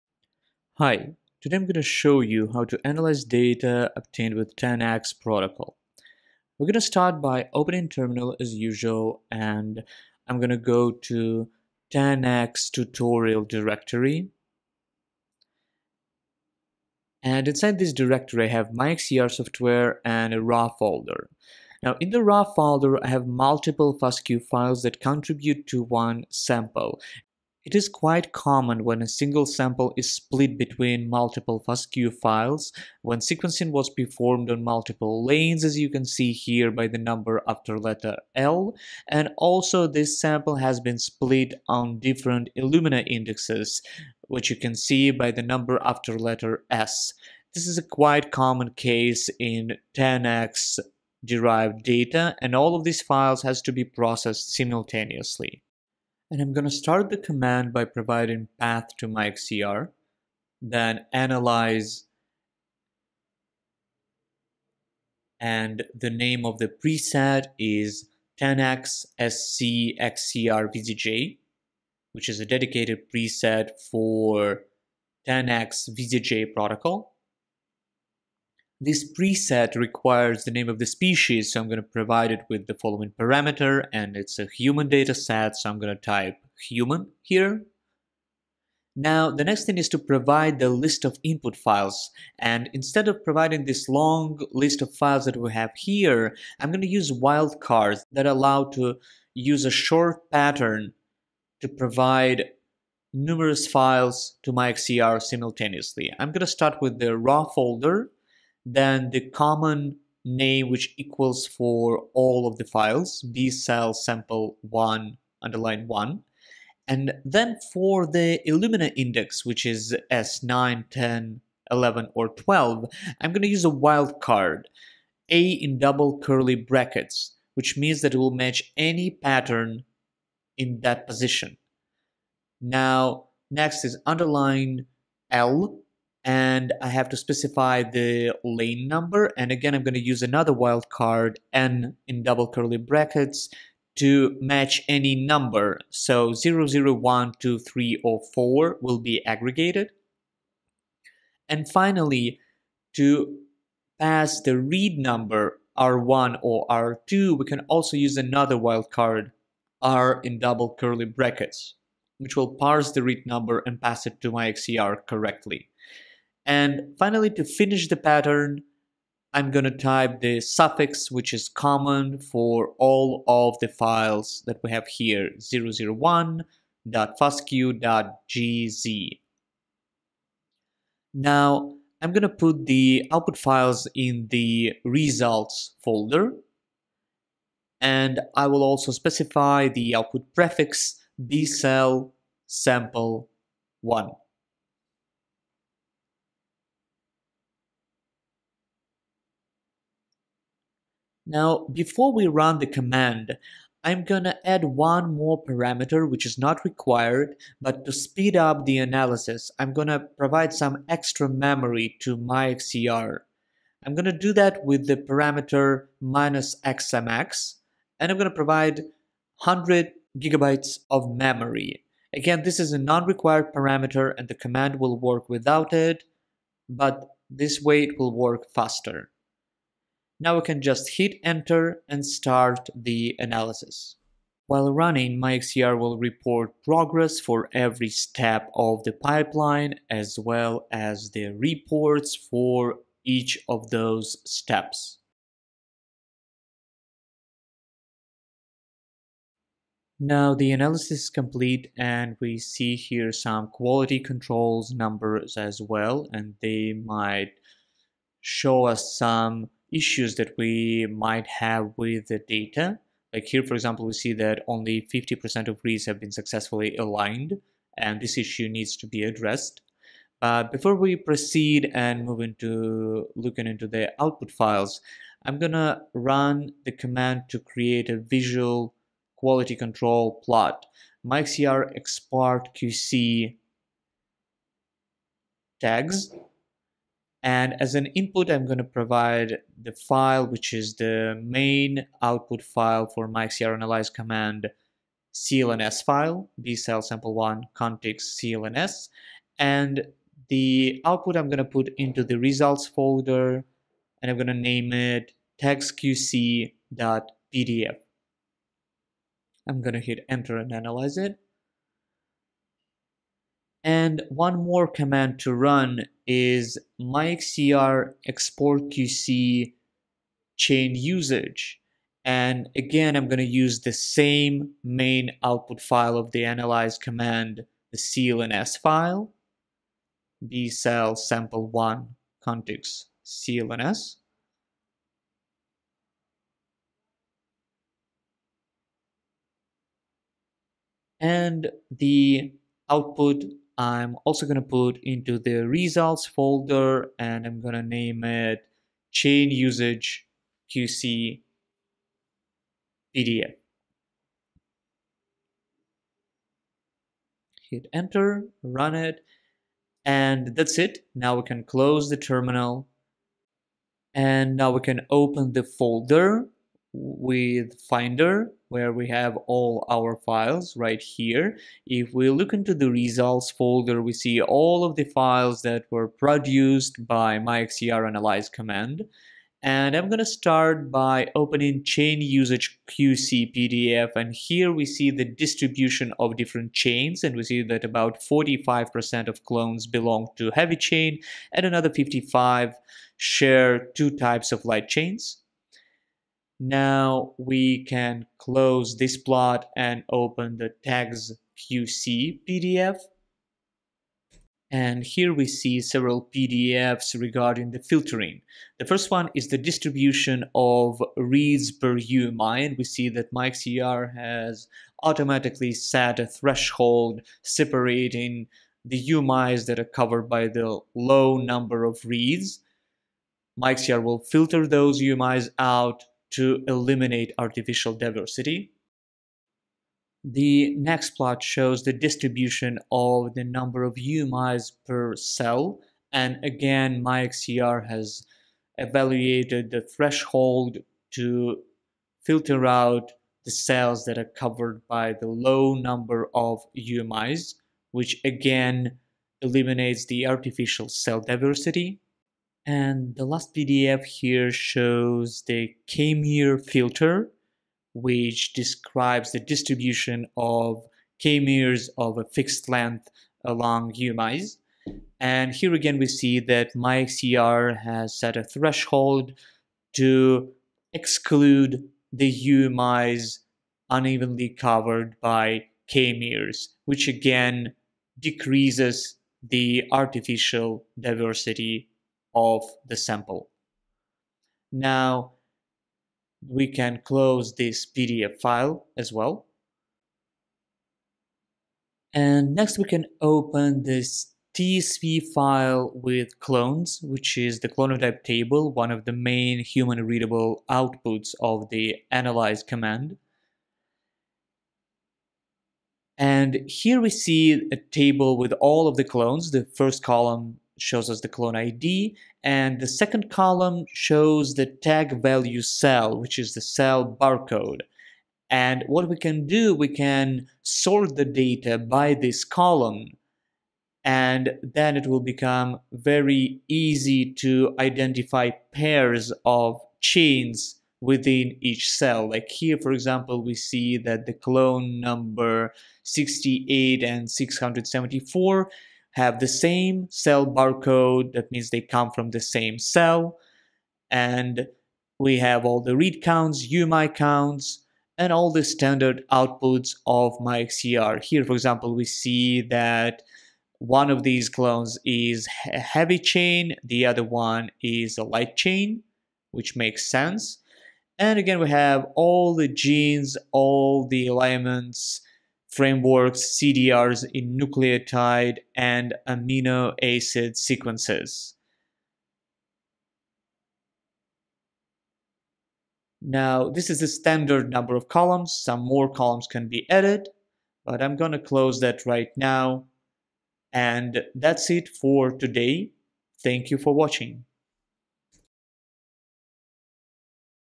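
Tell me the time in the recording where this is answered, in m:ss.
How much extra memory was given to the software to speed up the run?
3:39.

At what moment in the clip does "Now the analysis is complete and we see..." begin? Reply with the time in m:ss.
4:09.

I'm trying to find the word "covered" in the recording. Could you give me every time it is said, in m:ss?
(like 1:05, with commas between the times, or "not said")
6:59, 7:24, 7:54.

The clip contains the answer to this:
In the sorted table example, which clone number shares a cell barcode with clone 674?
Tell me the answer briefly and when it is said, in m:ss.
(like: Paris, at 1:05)
68, at 8:55.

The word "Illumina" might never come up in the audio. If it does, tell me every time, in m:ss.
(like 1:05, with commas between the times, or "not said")
0:42, 1:58.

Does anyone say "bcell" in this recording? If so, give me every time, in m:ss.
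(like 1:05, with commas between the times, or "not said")
3:11, 4:56, 5:30.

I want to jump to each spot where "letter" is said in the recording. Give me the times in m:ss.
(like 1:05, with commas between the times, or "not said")
0:37, 0:46.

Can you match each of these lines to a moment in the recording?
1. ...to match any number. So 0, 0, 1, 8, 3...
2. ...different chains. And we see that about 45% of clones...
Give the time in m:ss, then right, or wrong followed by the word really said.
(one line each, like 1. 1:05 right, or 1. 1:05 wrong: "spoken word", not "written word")
1. 2:23 wrong: "2", not "8"
2. 6:26 right.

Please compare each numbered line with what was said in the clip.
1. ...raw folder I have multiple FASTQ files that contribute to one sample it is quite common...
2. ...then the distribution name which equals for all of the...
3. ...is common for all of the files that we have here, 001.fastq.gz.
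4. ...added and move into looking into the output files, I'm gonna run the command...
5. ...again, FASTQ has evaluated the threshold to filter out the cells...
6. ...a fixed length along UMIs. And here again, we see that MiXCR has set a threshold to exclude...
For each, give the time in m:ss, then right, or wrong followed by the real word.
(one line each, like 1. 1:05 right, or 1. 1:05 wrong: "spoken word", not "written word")
1. 0:22 right
2. 1:48 wrong: "common", not "distribution"
3. 2:51 right
4. 4:30 wrong: "proceed", not "added"
5. 7:16 wrong: "MiXCR", not "FASTQ"
6. 7:41 right.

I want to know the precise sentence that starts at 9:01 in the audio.
That means they come from the same cell.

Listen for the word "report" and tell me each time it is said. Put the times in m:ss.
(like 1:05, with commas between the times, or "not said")
3:55, 4:01.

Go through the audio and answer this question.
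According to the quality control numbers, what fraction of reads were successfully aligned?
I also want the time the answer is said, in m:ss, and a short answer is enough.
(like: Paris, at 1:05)
50%, at 4:24.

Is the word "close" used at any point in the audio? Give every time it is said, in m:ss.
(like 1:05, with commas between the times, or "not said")
6:01, 6:38, 8:06, 9:41.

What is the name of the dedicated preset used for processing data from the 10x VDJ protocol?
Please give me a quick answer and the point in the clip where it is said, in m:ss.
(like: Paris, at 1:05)
10x SC XCR VDJ, at 1:08.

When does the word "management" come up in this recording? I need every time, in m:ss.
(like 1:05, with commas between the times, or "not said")
not said.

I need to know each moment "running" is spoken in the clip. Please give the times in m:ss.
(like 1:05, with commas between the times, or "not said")
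3:54.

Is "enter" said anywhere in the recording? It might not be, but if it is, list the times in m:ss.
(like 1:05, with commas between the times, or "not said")
3:51, 5:10, 5:57.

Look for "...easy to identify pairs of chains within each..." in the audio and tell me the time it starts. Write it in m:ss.
8:46.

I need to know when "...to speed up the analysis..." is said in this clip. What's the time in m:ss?
3:27.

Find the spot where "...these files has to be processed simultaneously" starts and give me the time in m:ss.
0:52.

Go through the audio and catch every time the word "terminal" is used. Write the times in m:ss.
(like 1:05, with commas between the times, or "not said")
0:07, 6:01.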